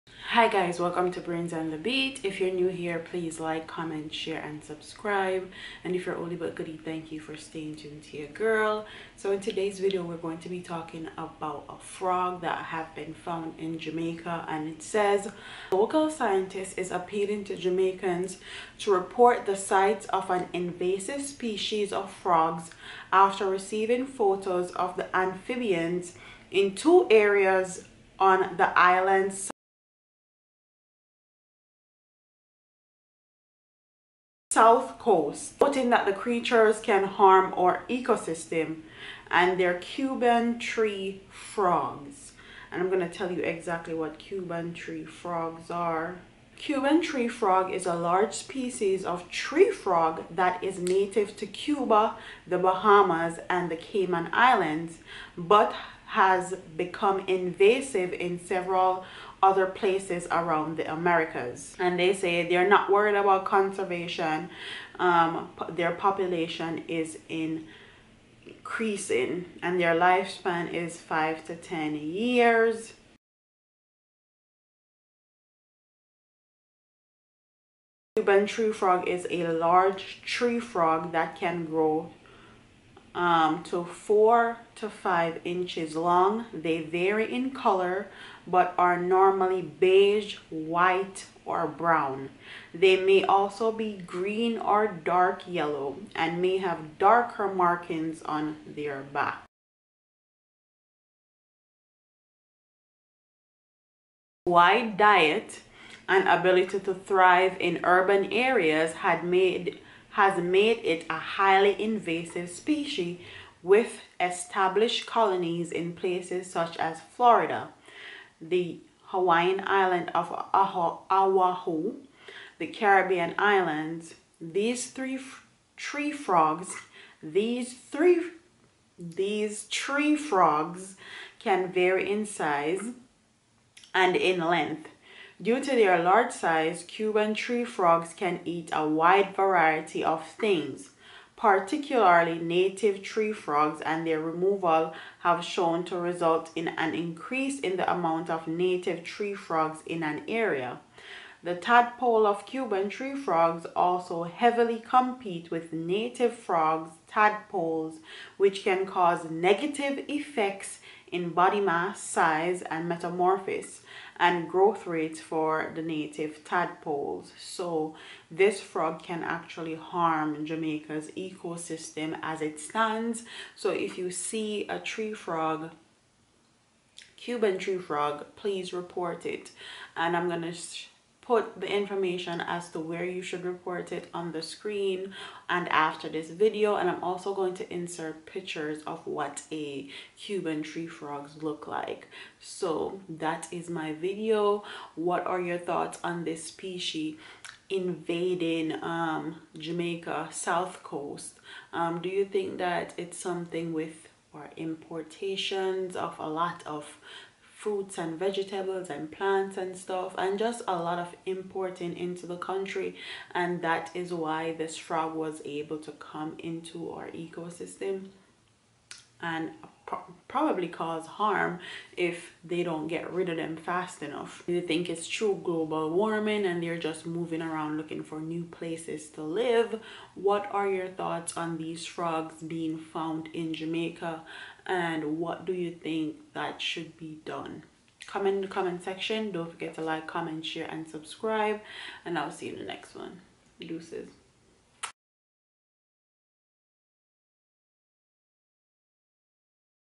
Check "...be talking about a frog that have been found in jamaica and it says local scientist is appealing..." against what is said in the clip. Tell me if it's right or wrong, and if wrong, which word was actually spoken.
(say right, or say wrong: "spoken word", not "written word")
right.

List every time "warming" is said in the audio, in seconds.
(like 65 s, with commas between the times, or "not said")
225 s.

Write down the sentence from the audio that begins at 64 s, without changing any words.
Um, their population is increasing and their lifespan is five to 10 years.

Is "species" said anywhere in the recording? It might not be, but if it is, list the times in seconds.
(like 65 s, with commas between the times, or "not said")
21 s, 48 s, 112 s, 196 s.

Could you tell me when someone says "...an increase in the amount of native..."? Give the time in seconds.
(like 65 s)
146 s.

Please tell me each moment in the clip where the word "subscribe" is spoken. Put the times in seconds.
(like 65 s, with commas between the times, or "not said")
4 s, 240 s.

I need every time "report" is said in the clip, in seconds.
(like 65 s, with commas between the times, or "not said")
18 s, 178 s, 183 s.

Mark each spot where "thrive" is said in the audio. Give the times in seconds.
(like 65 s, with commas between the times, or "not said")
106 s.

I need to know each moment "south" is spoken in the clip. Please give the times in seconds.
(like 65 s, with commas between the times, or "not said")
34 s, 200 s.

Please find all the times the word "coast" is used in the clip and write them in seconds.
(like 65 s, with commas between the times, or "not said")
34 s, 200 s.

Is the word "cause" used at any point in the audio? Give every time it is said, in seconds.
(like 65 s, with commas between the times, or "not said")
158 s, 220 s.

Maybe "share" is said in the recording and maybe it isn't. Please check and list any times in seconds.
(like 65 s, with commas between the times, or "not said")
4 s, 240 s.